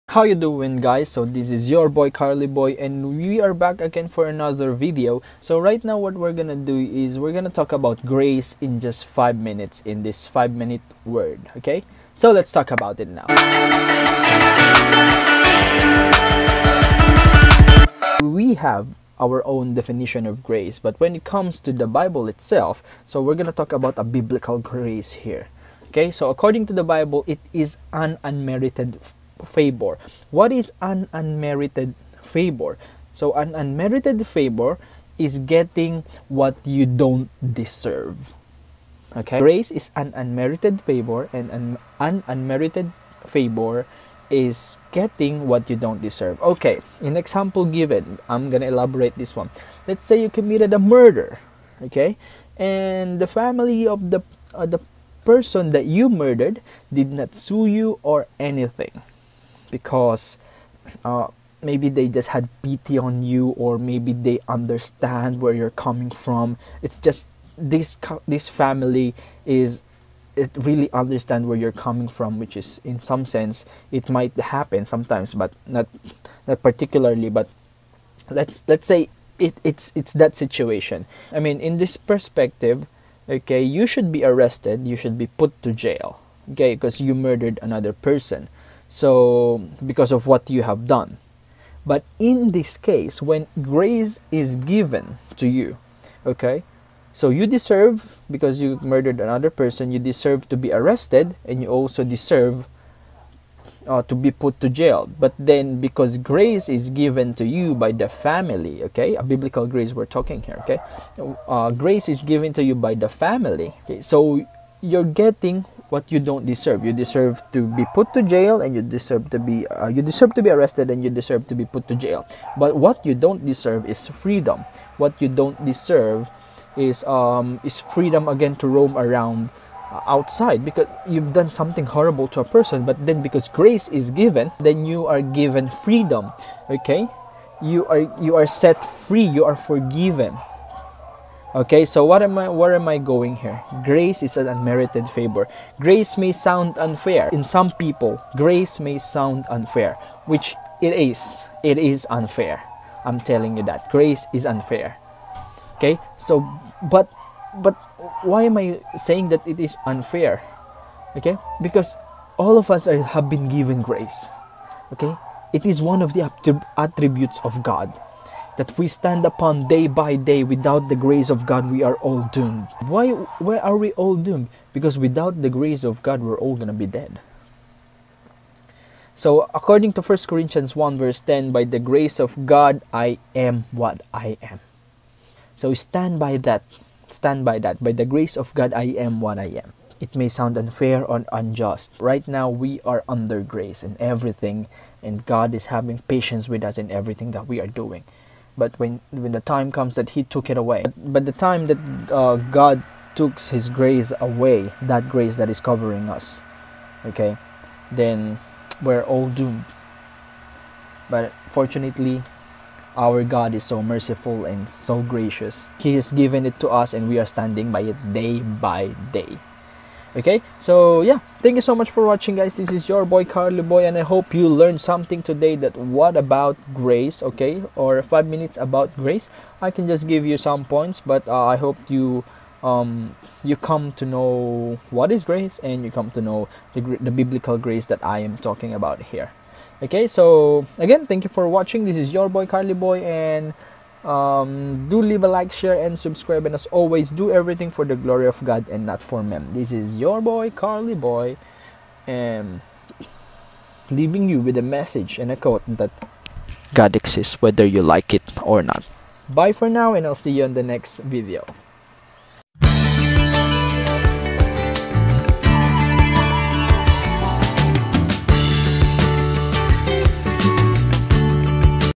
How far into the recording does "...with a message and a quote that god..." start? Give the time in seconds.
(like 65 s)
254 s.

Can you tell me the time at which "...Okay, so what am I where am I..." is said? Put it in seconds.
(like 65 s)
141 s.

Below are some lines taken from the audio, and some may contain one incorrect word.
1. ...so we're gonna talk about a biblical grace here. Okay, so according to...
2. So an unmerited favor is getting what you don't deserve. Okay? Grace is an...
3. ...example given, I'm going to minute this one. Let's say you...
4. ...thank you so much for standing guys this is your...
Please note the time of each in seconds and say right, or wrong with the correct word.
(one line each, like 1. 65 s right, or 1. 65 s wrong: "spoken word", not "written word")
1. 23 s right
2. 33 s right
3. 47 s wrong: "elaborate", not "minute"
4. 221 s wrong: "watching", not "standing".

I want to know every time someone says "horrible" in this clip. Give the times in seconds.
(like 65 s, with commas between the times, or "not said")
131 s.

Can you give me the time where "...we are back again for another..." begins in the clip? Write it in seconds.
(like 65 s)
3 s.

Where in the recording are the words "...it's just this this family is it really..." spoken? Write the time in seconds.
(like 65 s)
66 s.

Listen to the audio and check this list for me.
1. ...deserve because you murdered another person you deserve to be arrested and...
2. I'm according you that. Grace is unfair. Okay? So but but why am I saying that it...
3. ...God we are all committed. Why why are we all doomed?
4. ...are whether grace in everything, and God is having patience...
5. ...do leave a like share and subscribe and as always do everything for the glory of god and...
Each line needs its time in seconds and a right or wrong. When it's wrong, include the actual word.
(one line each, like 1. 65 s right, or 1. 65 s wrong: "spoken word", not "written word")
1. 97 s right
2. 153 s wrong: "telling", not "according"
3. 171 s wrong: "doomed", not "committed"
4. 192 s wrong: "under", not "whether"
5. 244 s right.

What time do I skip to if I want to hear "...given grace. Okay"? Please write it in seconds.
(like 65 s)
163 s.